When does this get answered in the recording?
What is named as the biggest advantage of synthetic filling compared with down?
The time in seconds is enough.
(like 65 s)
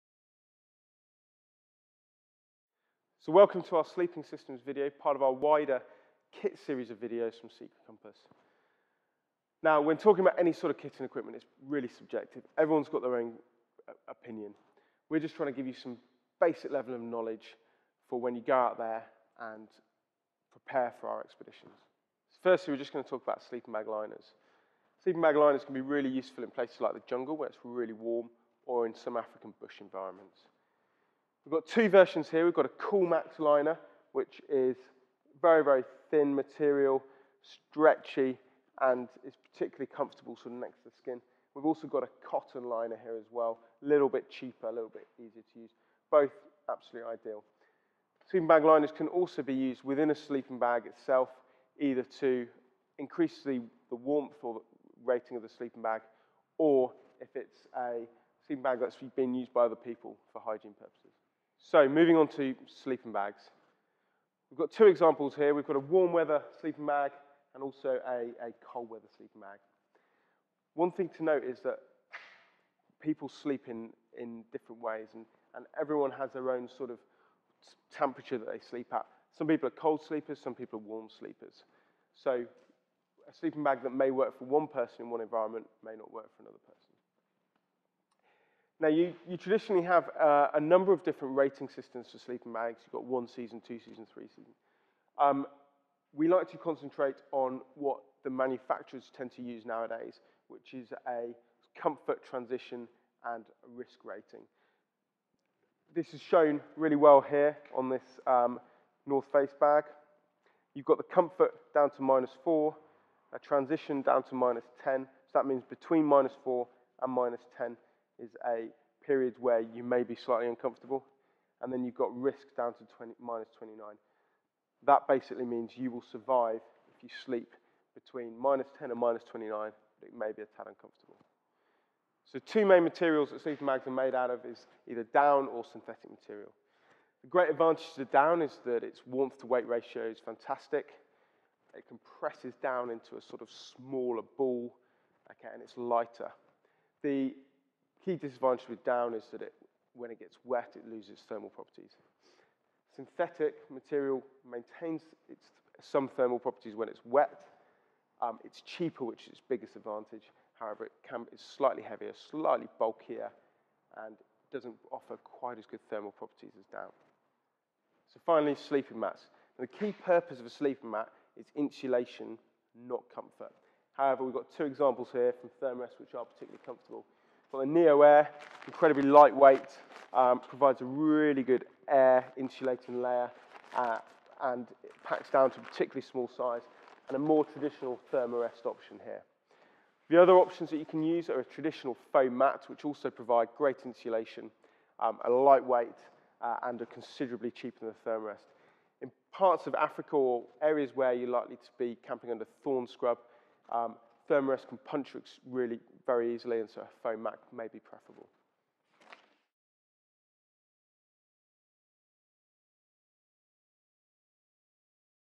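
158 s.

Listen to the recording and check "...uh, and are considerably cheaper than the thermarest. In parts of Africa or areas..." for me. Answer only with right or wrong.
right.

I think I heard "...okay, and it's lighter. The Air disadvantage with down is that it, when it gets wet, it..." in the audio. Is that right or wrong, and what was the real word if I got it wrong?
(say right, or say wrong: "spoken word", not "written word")
wrong: "Key", not "Air".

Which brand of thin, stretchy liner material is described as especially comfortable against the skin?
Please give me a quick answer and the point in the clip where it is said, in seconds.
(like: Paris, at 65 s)
Coolmax, at 32 s.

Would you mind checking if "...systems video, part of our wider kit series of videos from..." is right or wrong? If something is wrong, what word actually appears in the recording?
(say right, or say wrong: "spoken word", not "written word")
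right.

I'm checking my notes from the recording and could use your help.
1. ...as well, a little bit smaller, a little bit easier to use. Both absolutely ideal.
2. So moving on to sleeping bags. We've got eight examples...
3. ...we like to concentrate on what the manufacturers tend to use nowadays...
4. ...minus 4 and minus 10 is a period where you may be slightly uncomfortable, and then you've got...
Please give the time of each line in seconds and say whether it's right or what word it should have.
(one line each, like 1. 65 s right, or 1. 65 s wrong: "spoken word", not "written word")
1. 43 s wrong: "cheaper", not "smaller"
2. 61 s wrong: "two", not "eight"
3. 96 s right
4. 116 s right.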